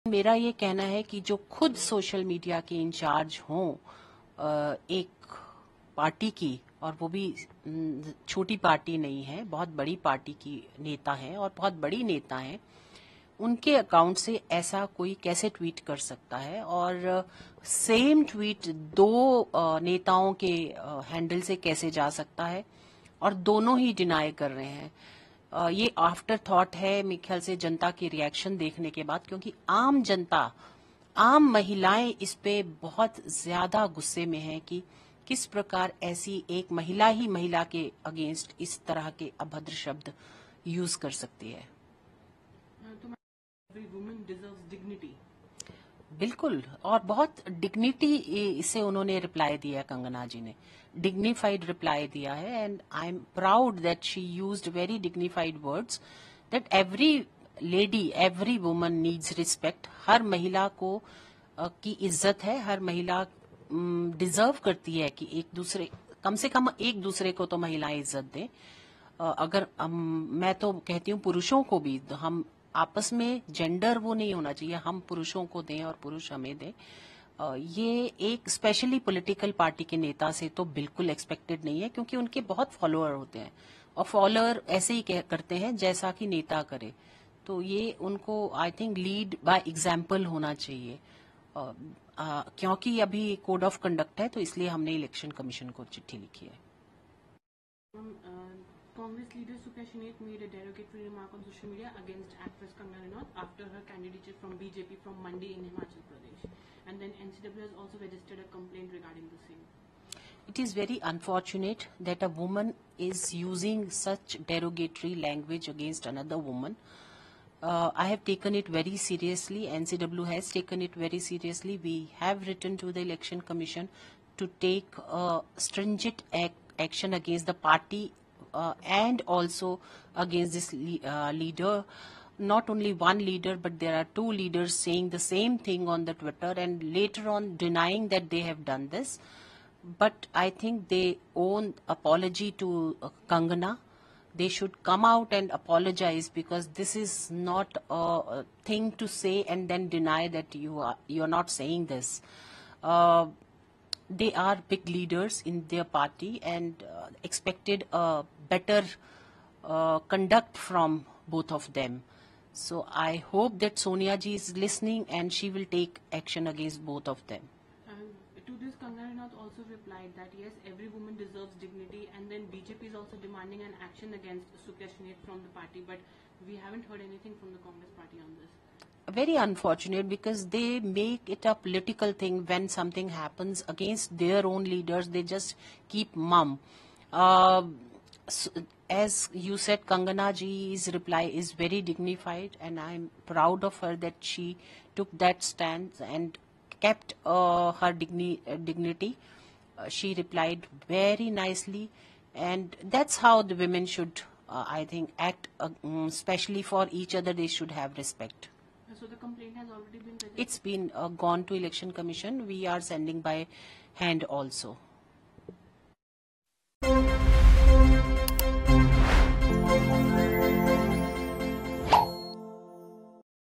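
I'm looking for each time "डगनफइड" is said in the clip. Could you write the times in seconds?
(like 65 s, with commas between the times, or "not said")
51 s, 55 s.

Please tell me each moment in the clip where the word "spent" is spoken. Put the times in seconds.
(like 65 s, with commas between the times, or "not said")
not said.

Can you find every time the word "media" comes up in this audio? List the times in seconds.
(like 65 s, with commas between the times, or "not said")
101 s.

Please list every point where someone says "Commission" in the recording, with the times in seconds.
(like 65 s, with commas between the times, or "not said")
123 s, 211 s.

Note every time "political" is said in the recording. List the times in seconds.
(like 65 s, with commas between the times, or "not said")
181 s.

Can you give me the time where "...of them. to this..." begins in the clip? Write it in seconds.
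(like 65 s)
167 s.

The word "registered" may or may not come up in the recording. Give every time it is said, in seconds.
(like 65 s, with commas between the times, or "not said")
108 s, 210 s.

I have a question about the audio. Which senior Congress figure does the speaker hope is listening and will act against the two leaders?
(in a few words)
Sonia ji.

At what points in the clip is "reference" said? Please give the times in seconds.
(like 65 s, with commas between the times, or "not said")
not said.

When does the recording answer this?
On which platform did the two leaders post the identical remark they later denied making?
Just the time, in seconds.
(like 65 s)
136 s.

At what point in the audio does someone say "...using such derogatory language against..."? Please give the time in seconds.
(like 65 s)
113 s.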